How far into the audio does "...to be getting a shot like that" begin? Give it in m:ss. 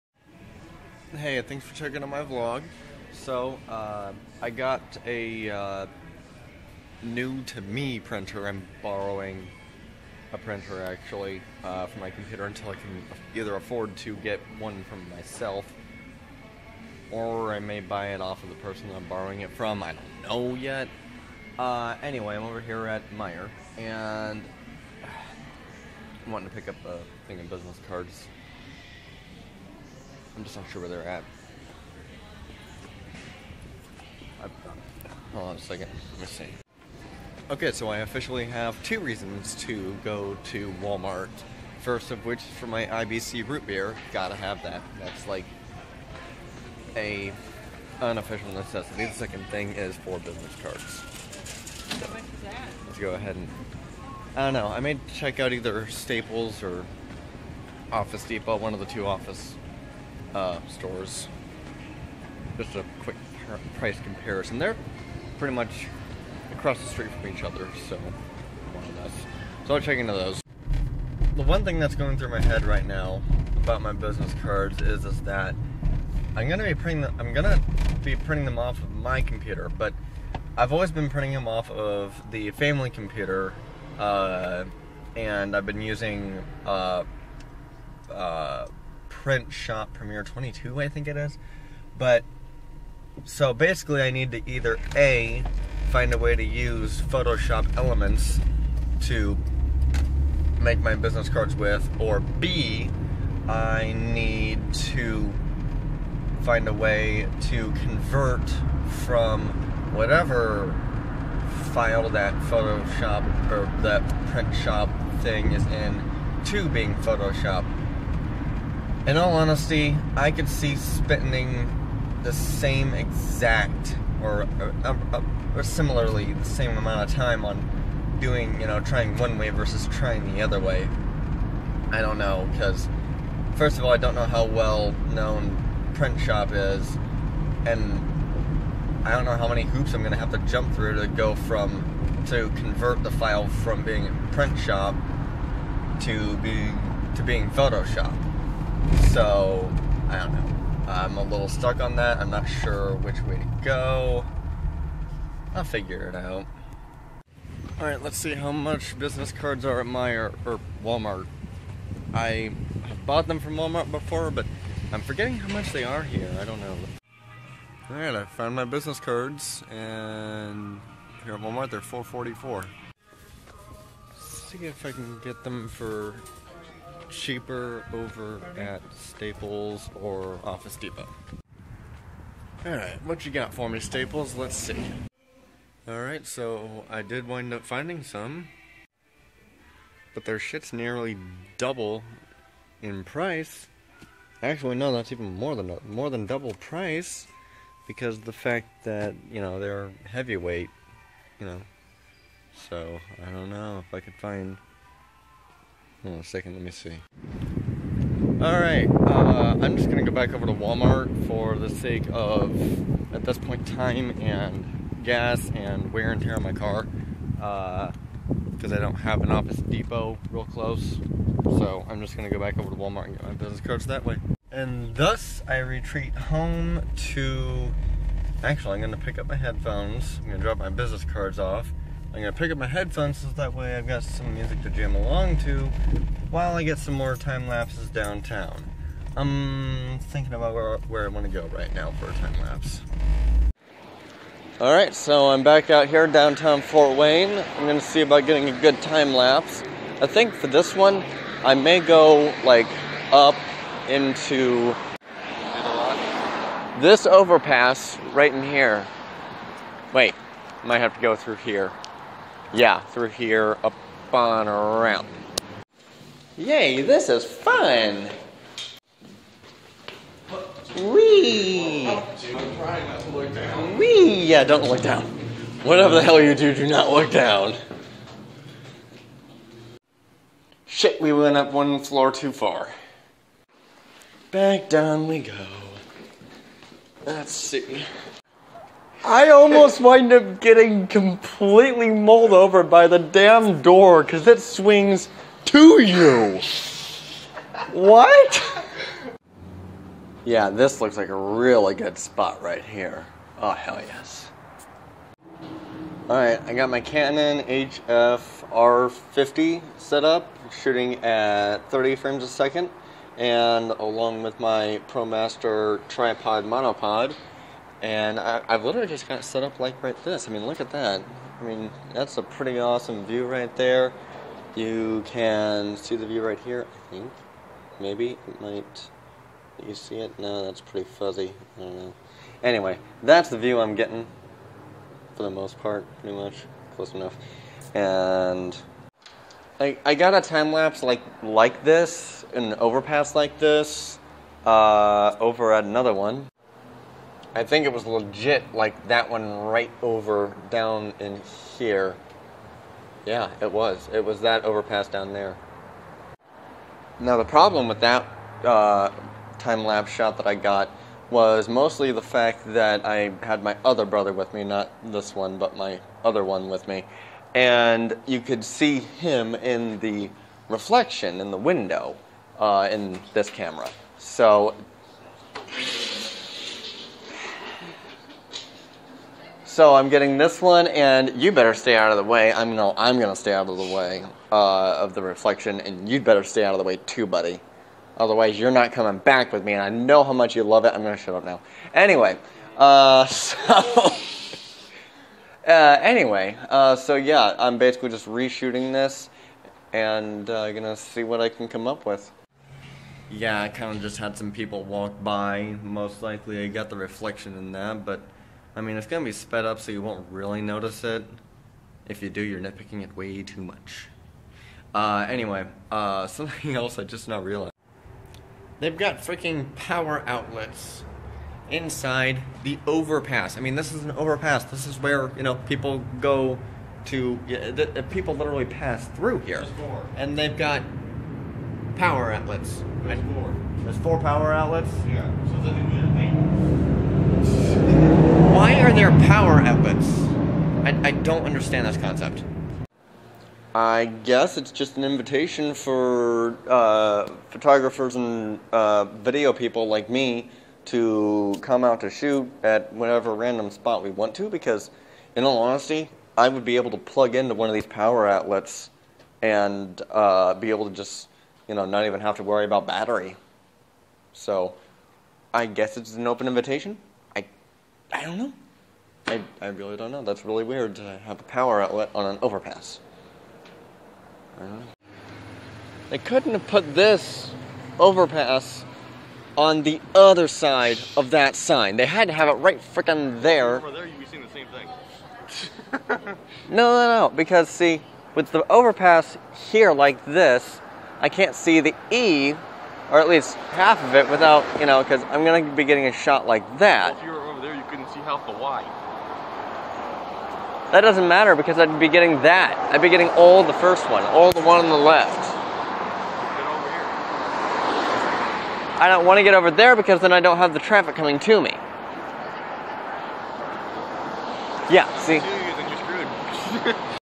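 8:15.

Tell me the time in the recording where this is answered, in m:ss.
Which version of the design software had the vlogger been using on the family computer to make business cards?
1:29.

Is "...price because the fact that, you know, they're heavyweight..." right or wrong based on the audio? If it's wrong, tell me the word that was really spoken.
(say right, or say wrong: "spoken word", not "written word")
right.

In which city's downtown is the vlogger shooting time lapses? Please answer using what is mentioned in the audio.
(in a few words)
Fort Wayne.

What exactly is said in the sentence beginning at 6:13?
So So I'm getting this one, and you better stay out of the way.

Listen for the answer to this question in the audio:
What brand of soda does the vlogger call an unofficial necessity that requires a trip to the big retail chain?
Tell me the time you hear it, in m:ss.
0:42.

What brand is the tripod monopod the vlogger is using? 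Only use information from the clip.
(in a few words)
ProMaster.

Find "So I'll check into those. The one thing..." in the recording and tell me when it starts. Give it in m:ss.
1:09.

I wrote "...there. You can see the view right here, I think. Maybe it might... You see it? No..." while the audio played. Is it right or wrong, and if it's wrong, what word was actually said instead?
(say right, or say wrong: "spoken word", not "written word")
right.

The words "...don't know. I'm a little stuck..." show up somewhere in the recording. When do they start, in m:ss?
2:30.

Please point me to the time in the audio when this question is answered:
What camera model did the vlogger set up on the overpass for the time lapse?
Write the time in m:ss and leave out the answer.
5:06.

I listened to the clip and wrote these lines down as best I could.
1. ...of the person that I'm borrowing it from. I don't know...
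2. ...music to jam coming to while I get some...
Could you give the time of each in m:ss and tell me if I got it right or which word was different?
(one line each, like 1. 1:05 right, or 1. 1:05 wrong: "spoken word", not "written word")
1. 0:18 right
2. 3:54 wrong: "along", not "coming".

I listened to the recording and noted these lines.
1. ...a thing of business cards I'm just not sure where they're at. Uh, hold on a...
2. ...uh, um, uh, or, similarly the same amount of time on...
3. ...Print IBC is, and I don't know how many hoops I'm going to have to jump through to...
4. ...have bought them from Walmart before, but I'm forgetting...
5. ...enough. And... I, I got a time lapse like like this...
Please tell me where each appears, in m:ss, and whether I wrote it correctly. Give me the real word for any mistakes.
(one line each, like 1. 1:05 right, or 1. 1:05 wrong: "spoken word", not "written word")
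1. 0:26 right
2. 2:04 right
3. 2:15 wrong: "Shop", not "IBC"
4. 2:42 right
5. 5:36 right.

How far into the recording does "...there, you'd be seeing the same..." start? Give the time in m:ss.
8:03.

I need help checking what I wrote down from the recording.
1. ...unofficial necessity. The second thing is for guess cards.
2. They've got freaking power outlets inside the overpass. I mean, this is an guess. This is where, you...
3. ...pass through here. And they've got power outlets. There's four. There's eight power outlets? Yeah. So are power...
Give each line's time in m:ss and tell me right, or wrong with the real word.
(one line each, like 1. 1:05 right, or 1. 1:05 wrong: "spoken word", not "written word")
1. 0:47 wrong: "business", not "guess"
2. 6:58 wrong: "overpass", not "guess"
3. 7:08 wrong: "four", not "eight".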